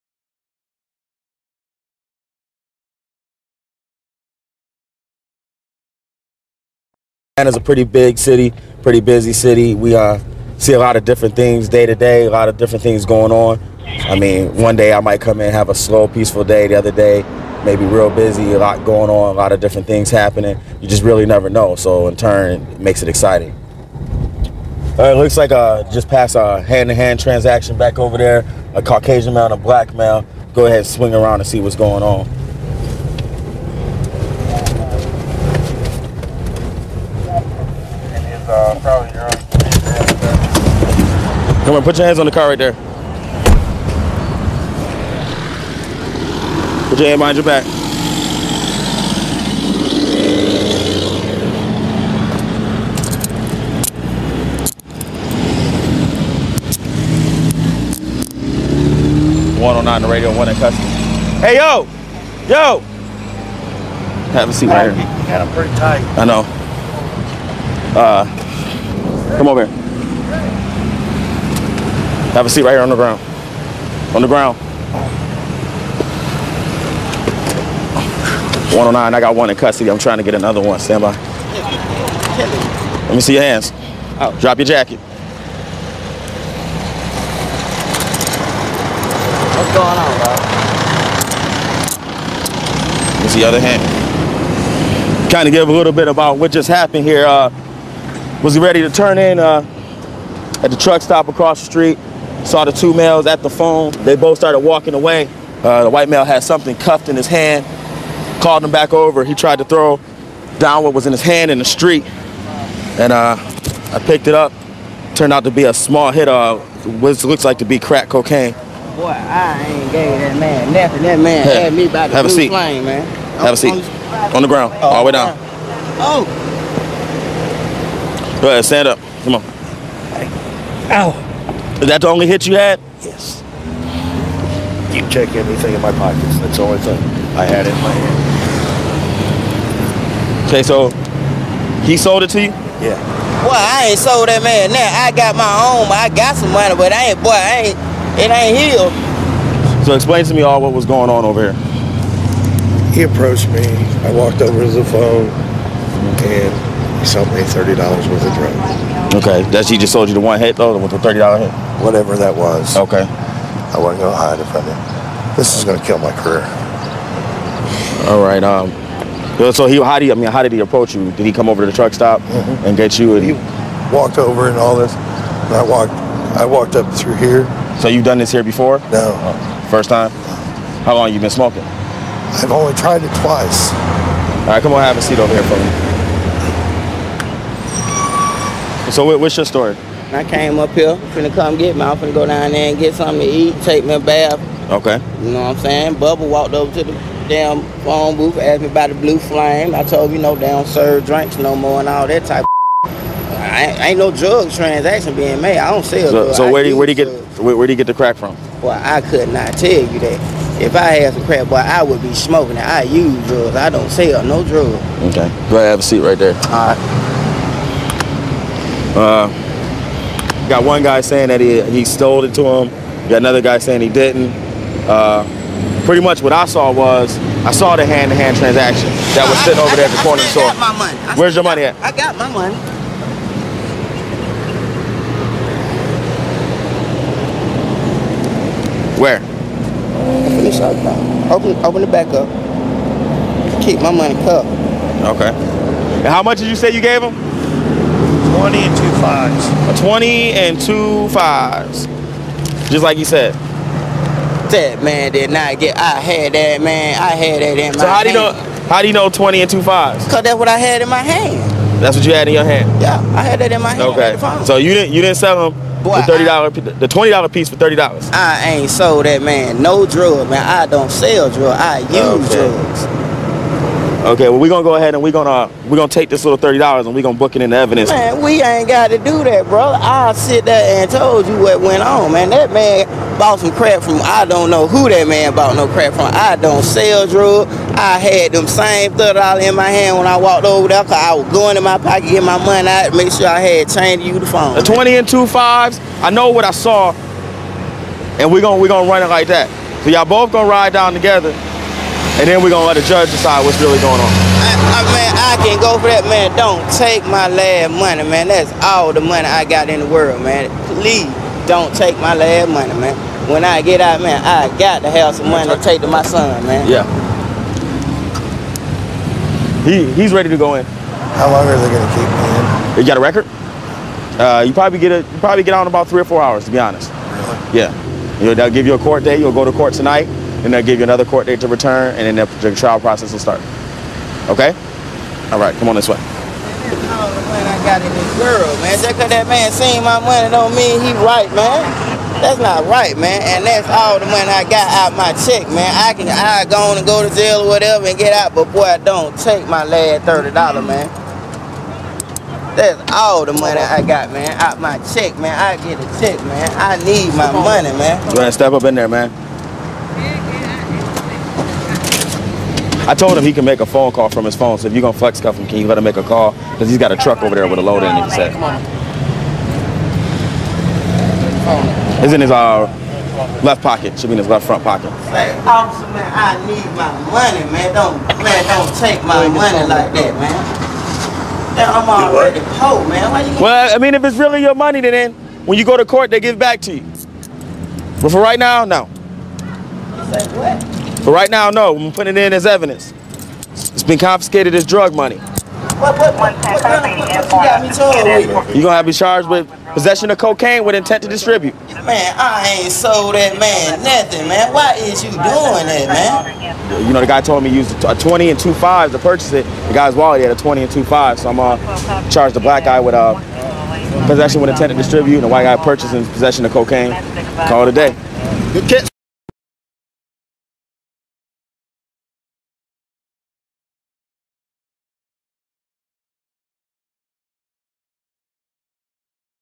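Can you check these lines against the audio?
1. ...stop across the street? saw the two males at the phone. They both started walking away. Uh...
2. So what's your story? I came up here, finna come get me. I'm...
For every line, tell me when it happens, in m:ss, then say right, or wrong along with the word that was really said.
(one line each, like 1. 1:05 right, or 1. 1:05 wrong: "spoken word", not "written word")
1. 1:41 right
2. 3:08 right.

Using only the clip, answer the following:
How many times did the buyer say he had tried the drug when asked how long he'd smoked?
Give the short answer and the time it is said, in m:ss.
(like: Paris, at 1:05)
twice, at 3:03.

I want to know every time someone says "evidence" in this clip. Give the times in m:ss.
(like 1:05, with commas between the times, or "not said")
4:37, 6:32.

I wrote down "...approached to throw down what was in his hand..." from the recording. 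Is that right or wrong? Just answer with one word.
wrong.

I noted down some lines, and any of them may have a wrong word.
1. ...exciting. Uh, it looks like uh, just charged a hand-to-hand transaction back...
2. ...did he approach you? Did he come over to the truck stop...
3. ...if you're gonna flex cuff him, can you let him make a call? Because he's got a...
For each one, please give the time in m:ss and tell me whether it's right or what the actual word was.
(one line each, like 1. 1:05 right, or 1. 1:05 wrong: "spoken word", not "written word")
1. 0:23 wrong: "passed", not "charged"
2. 2:50 right
3. 6:04 right.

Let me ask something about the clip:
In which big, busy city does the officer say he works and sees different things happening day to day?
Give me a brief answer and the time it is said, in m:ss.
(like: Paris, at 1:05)
Atlanta, at 0:07.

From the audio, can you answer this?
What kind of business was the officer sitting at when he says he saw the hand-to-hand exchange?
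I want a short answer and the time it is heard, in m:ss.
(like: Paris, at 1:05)
corner store, at 3:50.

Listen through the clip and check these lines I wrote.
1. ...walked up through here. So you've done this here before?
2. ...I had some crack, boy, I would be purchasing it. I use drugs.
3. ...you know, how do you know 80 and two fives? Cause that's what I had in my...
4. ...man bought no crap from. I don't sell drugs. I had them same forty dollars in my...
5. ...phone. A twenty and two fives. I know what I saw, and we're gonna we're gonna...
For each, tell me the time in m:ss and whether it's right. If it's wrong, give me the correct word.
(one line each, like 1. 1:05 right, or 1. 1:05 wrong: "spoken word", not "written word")
1. 2:56 right
2. 3:30 wrong: "smoking", not "purchasing"
3. 4:18 wrong: "20", not "80"
4. 4:45 wrong: "thirty", not "forty"
5. 4:54 right.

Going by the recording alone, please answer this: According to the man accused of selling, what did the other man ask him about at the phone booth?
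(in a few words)
the blue flame.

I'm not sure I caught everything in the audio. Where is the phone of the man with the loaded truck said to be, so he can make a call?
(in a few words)
left front pocket.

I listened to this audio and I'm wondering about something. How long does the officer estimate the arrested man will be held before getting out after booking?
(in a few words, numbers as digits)
3 or 4 hours.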